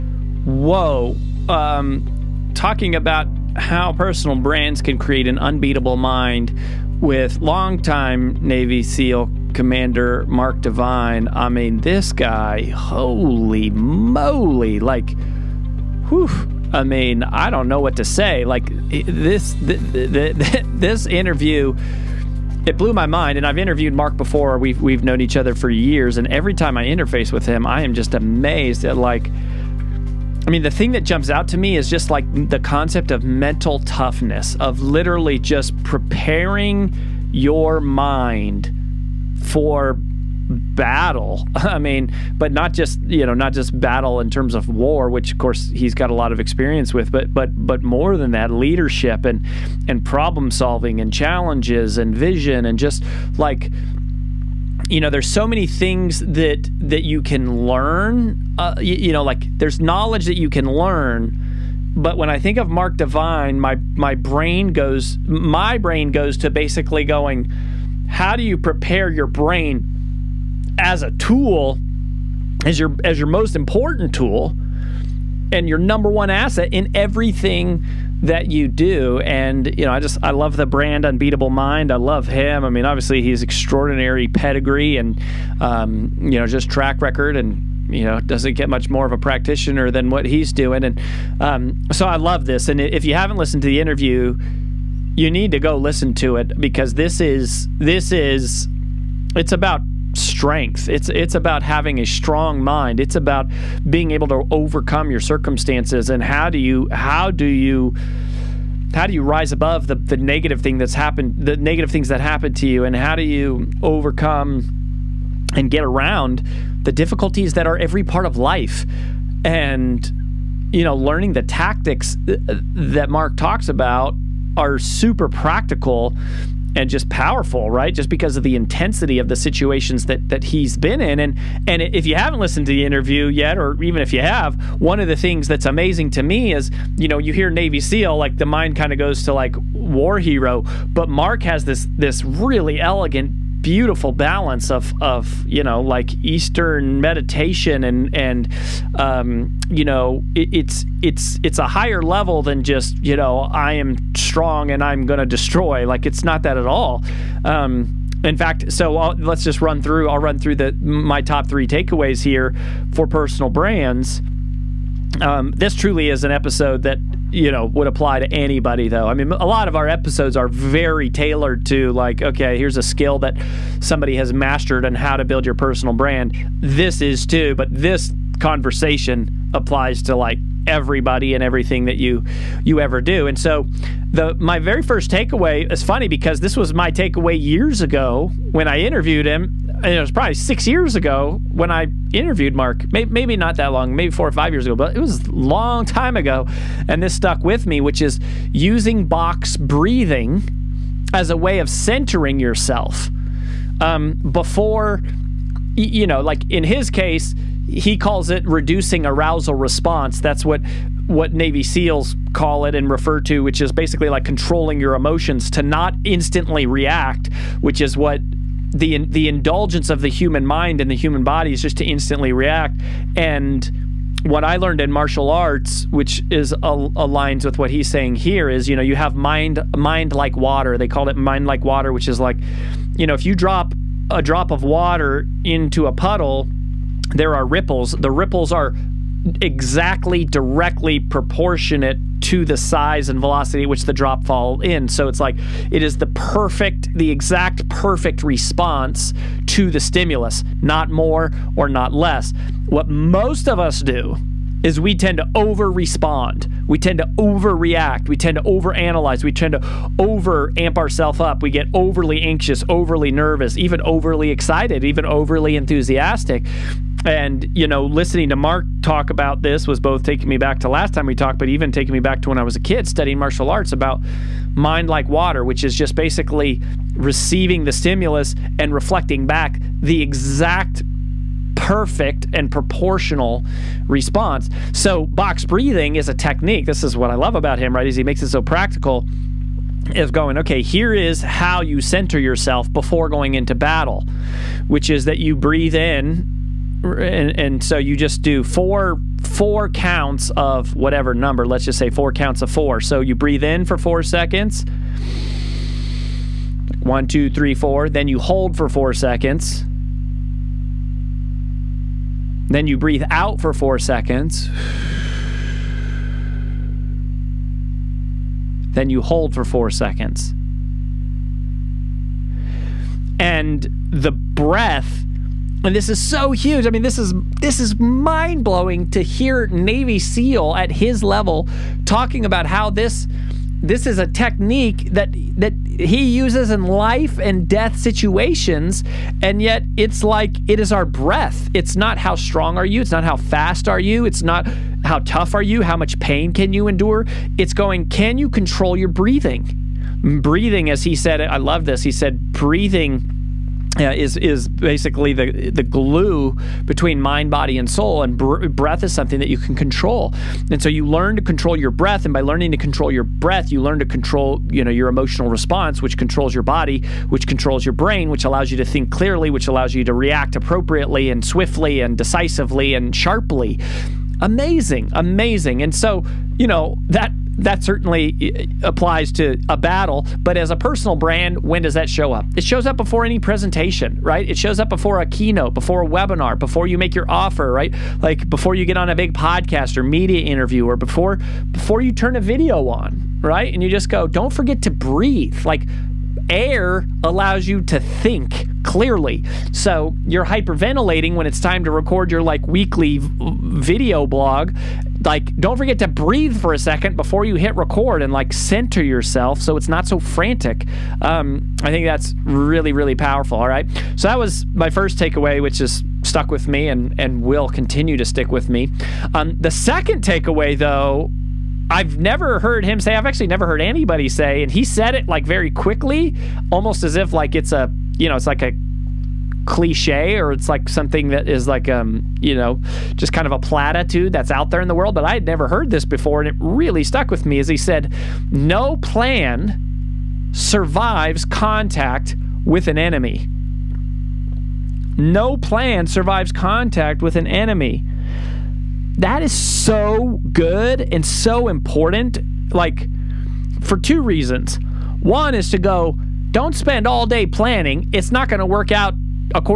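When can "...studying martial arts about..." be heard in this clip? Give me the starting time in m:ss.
4:32.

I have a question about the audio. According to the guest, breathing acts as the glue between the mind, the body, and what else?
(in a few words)
Soul.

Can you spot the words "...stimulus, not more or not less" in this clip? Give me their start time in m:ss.
4:09.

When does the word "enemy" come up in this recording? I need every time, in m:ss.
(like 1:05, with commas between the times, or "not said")
7:22, 7:27.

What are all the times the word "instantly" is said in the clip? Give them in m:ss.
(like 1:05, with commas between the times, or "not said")
3:36, 3:41.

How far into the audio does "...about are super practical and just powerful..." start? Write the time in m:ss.
2:03.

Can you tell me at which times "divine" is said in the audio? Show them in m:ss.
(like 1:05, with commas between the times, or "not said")
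0:10, 1:02.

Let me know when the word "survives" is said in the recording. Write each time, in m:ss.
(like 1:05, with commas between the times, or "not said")
7:20, 7:25.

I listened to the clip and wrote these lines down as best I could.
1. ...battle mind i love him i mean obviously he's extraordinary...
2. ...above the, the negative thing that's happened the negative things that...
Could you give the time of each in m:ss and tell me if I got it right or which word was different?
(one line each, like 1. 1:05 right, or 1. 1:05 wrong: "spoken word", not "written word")
1. 1:21 wrong: "unbeatable", not "battle"
2. 1:49 right.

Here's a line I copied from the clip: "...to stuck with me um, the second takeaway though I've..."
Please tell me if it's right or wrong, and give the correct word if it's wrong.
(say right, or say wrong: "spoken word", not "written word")
wrong: "stick", not "stuck".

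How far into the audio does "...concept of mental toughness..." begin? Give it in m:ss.
0:32.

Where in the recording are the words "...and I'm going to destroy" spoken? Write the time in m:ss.
2:34.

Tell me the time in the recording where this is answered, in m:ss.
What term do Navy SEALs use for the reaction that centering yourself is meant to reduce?
3:29.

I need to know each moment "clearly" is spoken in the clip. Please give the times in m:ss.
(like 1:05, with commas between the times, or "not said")
6:08, 6:38.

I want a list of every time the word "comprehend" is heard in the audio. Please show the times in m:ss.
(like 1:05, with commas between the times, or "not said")
not said.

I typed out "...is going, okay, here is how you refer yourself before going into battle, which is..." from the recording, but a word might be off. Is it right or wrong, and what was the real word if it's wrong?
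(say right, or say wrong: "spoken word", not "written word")
wrong: "center", not "refer".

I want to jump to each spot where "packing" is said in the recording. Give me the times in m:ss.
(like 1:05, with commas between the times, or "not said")
not said.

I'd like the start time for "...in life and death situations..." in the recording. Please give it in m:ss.
5:36.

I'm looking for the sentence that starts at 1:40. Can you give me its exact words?
It's it's about having a strong mind.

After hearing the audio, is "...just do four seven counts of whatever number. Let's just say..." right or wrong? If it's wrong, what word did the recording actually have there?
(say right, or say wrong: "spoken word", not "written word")
wrong: "four", not "seven".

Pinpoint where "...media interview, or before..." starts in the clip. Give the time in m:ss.
6:29.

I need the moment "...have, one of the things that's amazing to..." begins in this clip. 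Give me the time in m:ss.
2:14.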